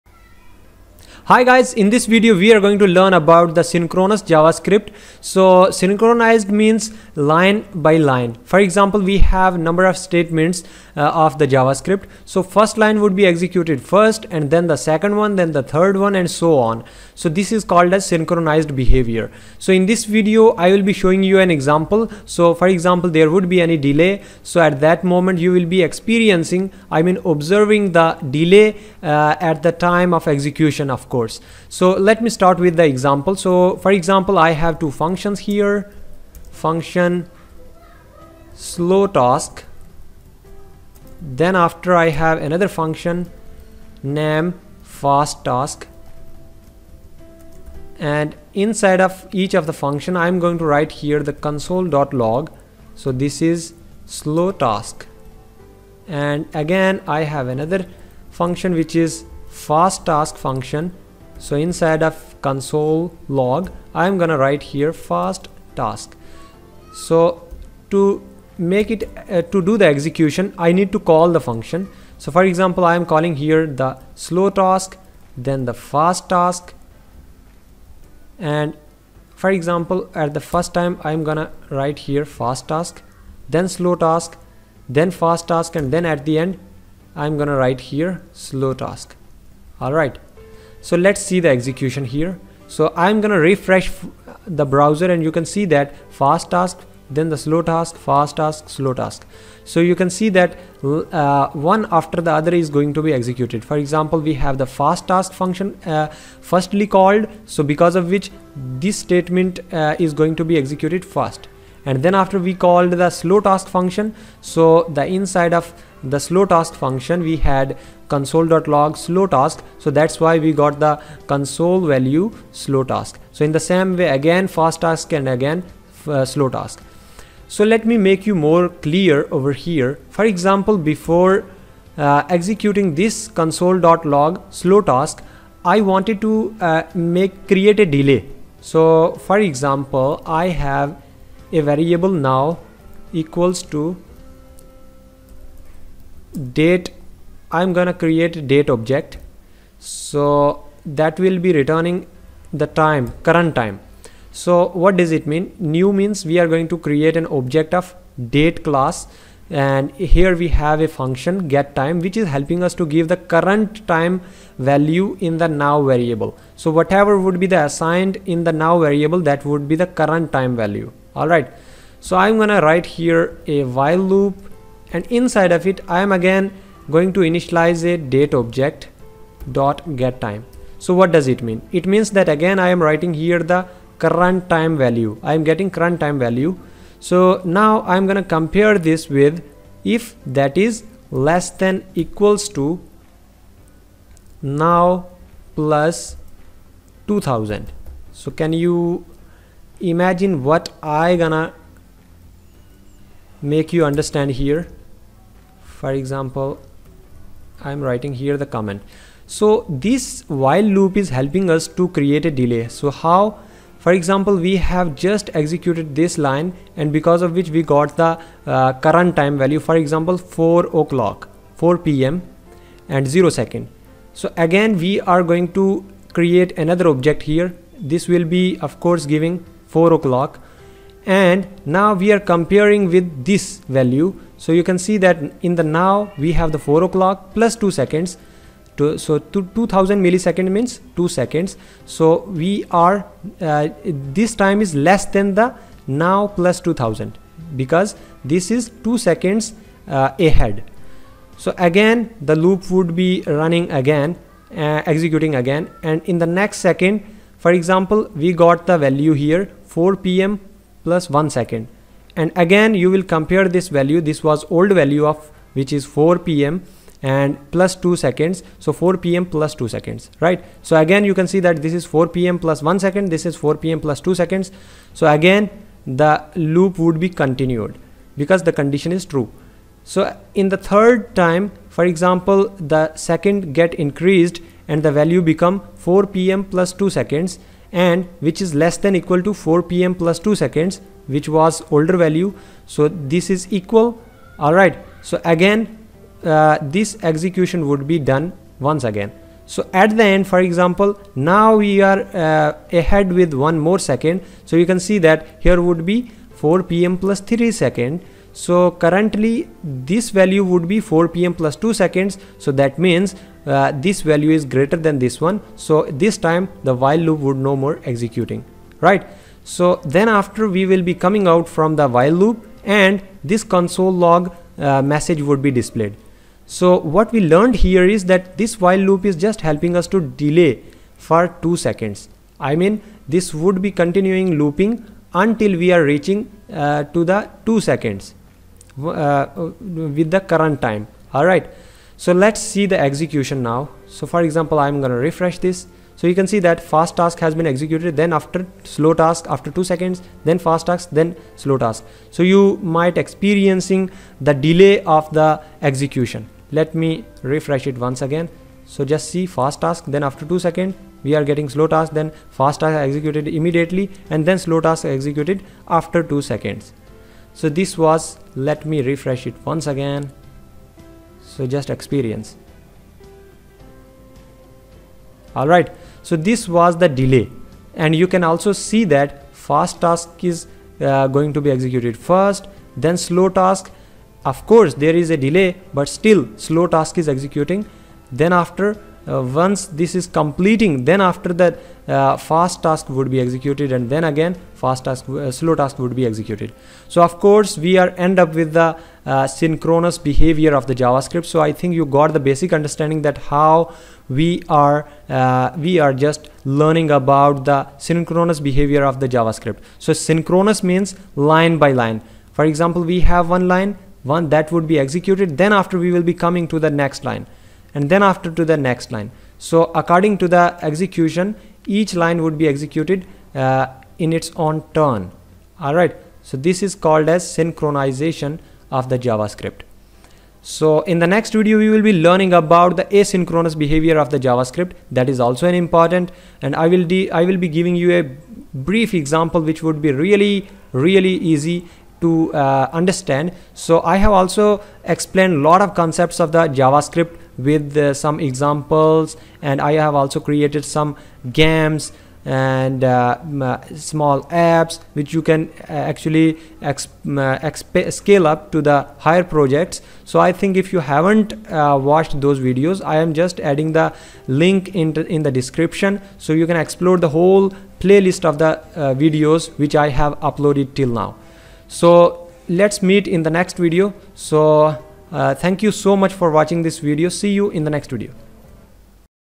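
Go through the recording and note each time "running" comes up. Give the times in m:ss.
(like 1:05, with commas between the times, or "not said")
4:13.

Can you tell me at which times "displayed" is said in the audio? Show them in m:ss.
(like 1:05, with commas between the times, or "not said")
5:25.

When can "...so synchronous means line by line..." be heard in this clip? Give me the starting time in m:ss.
6:49.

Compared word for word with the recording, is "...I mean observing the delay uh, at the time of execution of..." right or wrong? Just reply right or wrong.
right.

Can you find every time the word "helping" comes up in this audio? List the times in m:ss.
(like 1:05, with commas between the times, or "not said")
2:42, 3:31, 5:29.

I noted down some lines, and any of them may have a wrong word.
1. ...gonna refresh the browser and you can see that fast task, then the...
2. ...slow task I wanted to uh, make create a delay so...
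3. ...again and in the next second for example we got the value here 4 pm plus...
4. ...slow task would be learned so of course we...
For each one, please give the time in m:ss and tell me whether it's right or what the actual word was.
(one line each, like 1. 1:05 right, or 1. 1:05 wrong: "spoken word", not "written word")
1. 1:33 right
2. 2:14 right
3. 4:15 right
4. 6:35 wrong: "executed", not "learned".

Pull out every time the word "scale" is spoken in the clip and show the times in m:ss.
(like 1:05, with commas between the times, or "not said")
7:37.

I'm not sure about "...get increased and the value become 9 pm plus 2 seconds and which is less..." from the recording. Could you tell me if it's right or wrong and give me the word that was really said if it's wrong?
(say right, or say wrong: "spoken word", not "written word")
wrong: "4", not "9".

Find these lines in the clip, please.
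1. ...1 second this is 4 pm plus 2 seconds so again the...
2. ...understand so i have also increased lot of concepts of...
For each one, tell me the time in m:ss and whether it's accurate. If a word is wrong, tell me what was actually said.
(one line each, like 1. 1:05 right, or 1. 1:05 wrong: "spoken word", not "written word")
1. 4:32 right
2. 7:22 wrong: "explained", not "increased".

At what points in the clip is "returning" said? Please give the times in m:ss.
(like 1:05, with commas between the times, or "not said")
2:31.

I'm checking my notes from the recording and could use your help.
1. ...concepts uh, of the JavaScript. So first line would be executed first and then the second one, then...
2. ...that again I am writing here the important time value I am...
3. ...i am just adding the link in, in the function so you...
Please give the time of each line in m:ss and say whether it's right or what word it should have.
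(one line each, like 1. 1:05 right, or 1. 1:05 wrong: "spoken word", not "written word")
1. 0:09 wrong: "statements", not "concepts"
2. 3:02 wrong: "current", not "important"
3. 7:42 wrong: "description", not "function".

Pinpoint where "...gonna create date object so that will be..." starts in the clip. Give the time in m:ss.
2:27.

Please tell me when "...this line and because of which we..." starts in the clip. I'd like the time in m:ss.
3:36.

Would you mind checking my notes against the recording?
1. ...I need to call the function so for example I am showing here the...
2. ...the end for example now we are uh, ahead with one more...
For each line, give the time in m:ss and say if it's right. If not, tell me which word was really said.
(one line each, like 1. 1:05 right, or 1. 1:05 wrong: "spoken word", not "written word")
1. 1:10 wrong: "calling", not "showing"
2. 4:59 right.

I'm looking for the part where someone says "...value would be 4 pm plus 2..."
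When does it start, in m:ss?
5:10.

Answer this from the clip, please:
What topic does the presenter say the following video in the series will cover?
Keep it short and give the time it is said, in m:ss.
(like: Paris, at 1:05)
asynchronous behavior, at 7:12.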